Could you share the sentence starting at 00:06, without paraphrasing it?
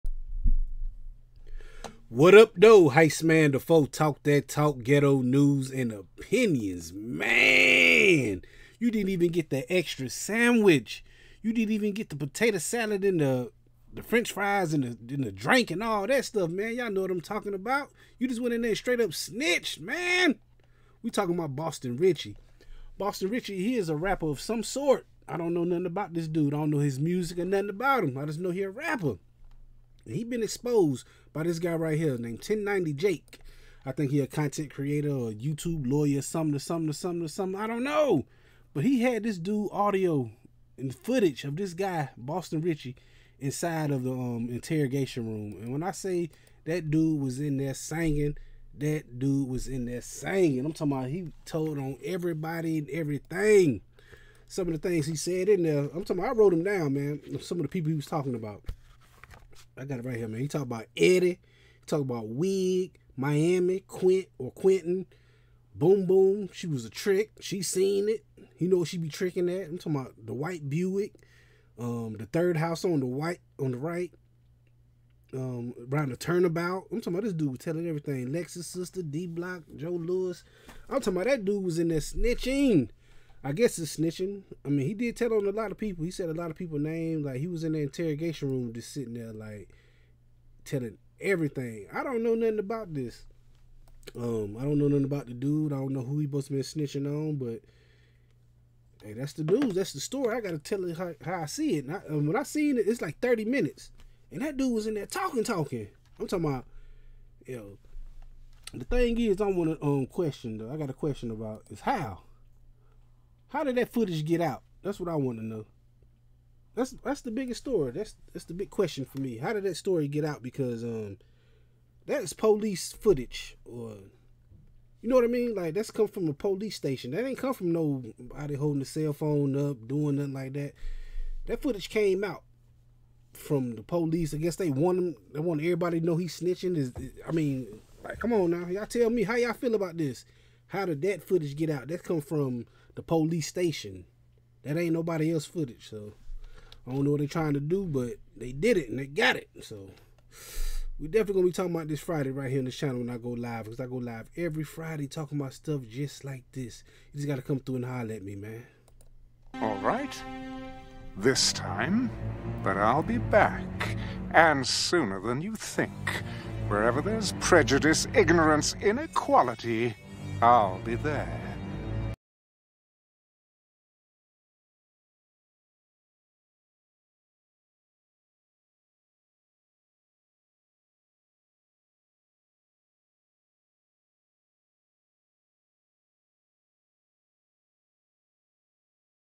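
Man, you didn't even get the extra sandwich.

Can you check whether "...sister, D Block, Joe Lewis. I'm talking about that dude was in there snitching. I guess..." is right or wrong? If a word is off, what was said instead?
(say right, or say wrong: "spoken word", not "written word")
right.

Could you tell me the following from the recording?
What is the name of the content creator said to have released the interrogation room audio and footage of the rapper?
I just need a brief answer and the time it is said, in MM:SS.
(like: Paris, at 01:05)
1090 Jake, at 00:32.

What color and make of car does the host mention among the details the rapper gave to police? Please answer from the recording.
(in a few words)
white Buick.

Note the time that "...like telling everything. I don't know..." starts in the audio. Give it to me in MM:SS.
01:29.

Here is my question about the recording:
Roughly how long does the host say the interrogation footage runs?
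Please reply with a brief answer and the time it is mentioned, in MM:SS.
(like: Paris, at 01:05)
30 minutes, at 01:43.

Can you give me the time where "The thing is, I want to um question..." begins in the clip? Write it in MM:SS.
01:48.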